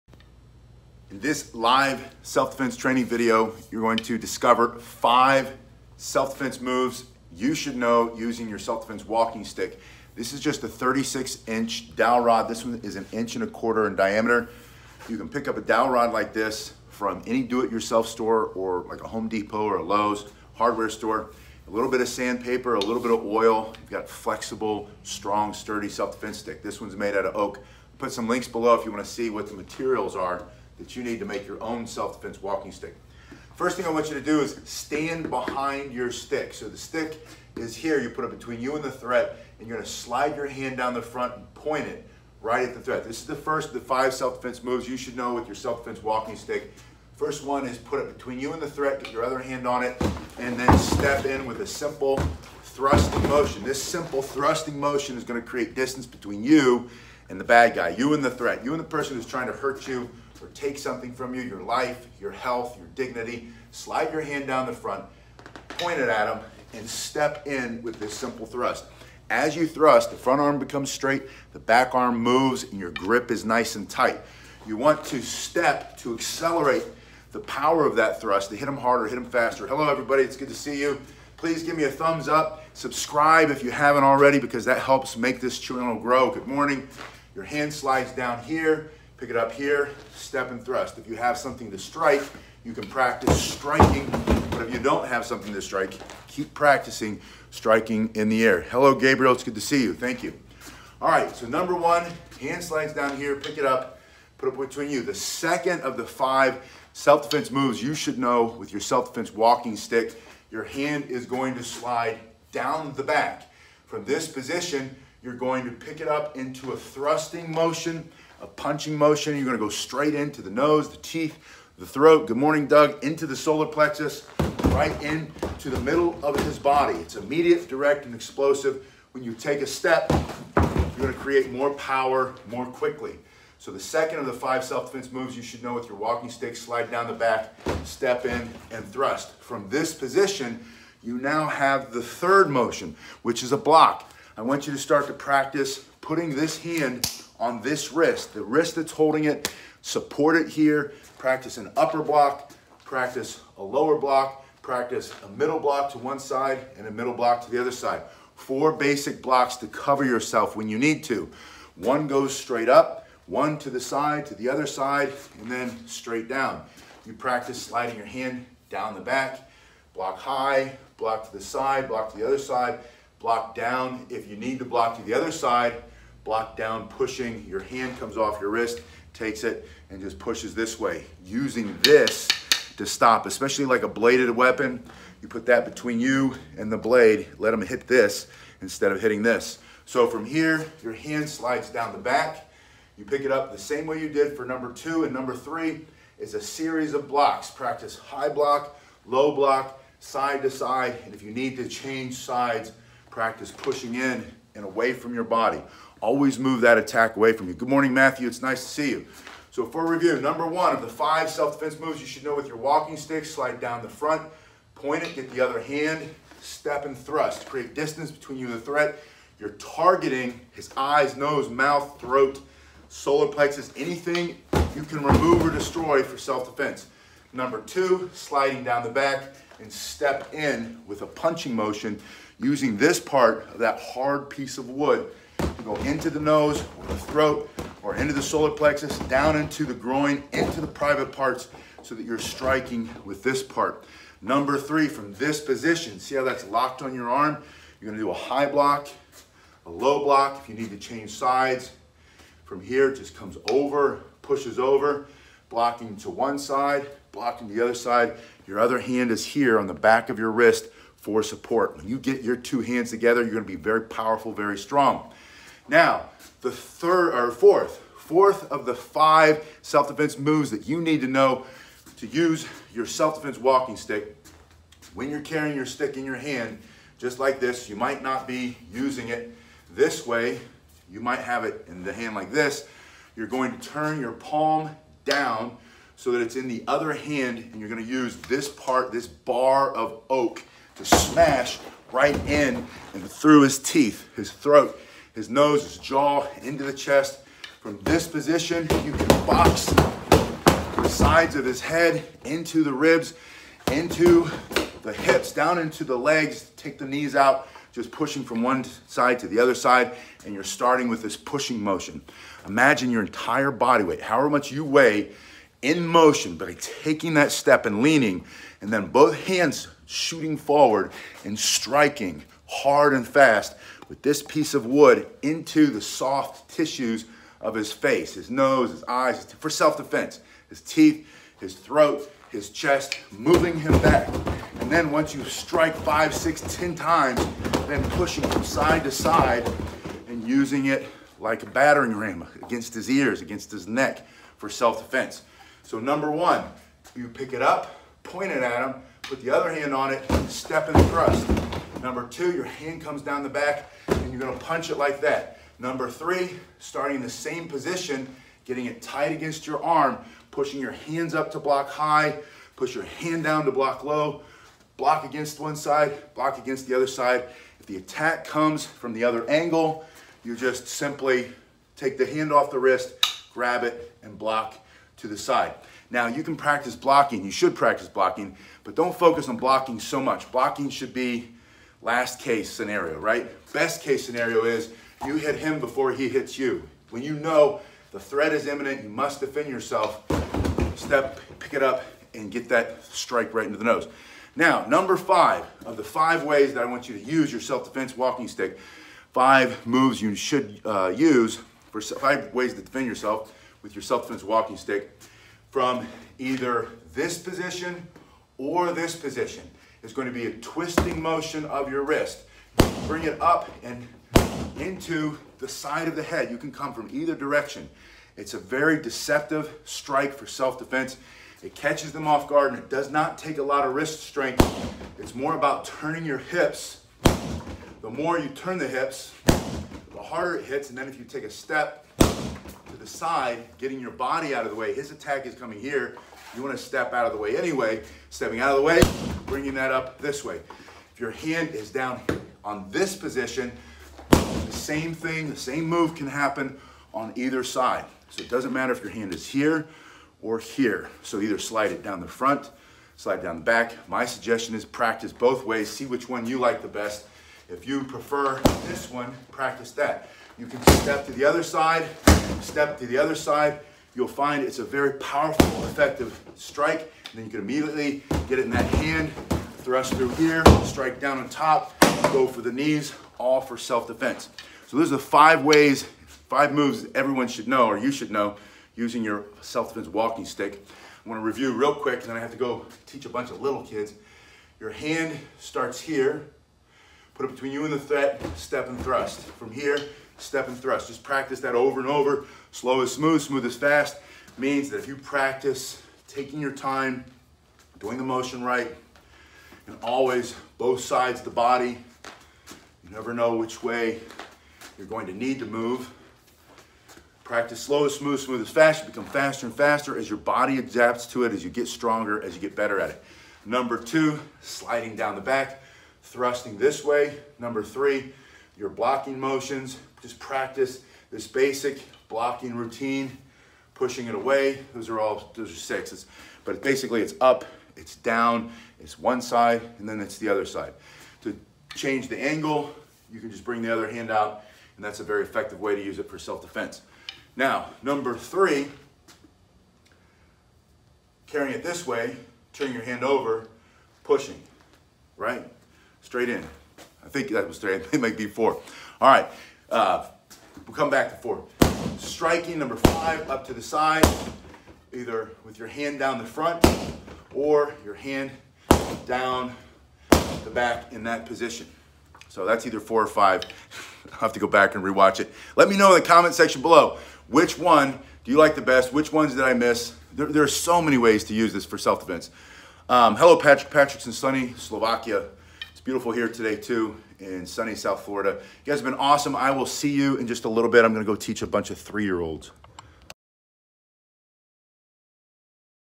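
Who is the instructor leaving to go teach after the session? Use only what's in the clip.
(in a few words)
three-year-olds.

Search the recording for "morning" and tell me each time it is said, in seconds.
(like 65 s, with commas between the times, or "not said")
86 s, 122 s, 207 s.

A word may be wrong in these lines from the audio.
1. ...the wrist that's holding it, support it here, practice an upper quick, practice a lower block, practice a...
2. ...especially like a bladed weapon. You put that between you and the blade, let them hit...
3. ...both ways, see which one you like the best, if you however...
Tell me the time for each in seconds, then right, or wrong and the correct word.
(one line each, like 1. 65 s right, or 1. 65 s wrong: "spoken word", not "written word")
1. 148 s wrong: "block", not "quick"
2. 183 s right
3. 455 s wrong: "prefer", not "however".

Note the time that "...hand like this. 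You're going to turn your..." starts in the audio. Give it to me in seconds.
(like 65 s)
281 s.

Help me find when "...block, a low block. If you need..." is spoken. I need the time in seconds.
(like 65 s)
248 s.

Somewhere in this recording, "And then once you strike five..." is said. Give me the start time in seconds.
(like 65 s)
334 s.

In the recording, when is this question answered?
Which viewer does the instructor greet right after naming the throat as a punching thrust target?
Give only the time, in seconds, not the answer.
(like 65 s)
122 s.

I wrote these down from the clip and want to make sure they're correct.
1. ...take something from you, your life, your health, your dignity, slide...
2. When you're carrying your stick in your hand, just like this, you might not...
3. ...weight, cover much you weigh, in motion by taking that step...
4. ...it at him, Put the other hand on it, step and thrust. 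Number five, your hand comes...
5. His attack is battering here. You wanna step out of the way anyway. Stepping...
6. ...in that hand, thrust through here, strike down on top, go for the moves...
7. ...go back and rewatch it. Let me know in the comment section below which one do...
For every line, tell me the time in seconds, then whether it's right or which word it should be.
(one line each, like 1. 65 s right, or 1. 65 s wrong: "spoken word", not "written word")
1. 60 s right
2. 274 s right
3. 313 s wrong: "however", not "cover"
4. 348 s wrong: "two", not "five"
5. 434 s wrong: "coming", not "battering"
6. 468 s wrong: "knees", not "moves"
7. 564 s right.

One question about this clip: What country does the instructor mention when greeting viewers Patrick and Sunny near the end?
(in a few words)
Slovakia.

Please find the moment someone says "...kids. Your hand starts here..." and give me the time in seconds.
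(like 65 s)
483 s.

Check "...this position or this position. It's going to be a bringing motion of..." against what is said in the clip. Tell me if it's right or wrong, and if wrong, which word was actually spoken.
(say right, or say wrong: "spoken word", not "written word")
wrong: "twisting", not "bringing".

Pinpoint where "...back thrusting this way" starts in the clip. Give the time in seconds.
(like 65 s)
515 s.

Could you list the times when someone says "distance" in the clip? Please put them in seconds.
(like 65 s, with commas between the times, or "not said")
55 s, 217 s.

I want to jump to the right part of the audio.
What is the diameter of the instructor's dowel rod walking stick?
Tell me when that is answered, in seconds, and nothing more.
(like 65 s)
12 s.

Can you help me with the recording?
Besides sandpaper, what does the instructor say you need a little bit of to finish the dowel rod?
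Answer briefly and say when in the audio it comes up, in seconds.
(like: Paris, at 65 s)
oil, at 22 s.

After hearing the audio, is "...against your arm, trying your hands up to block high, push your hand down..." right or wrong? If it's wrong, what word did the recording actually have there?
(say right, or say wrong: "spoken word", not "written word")
wrong: "pushing", not "trying".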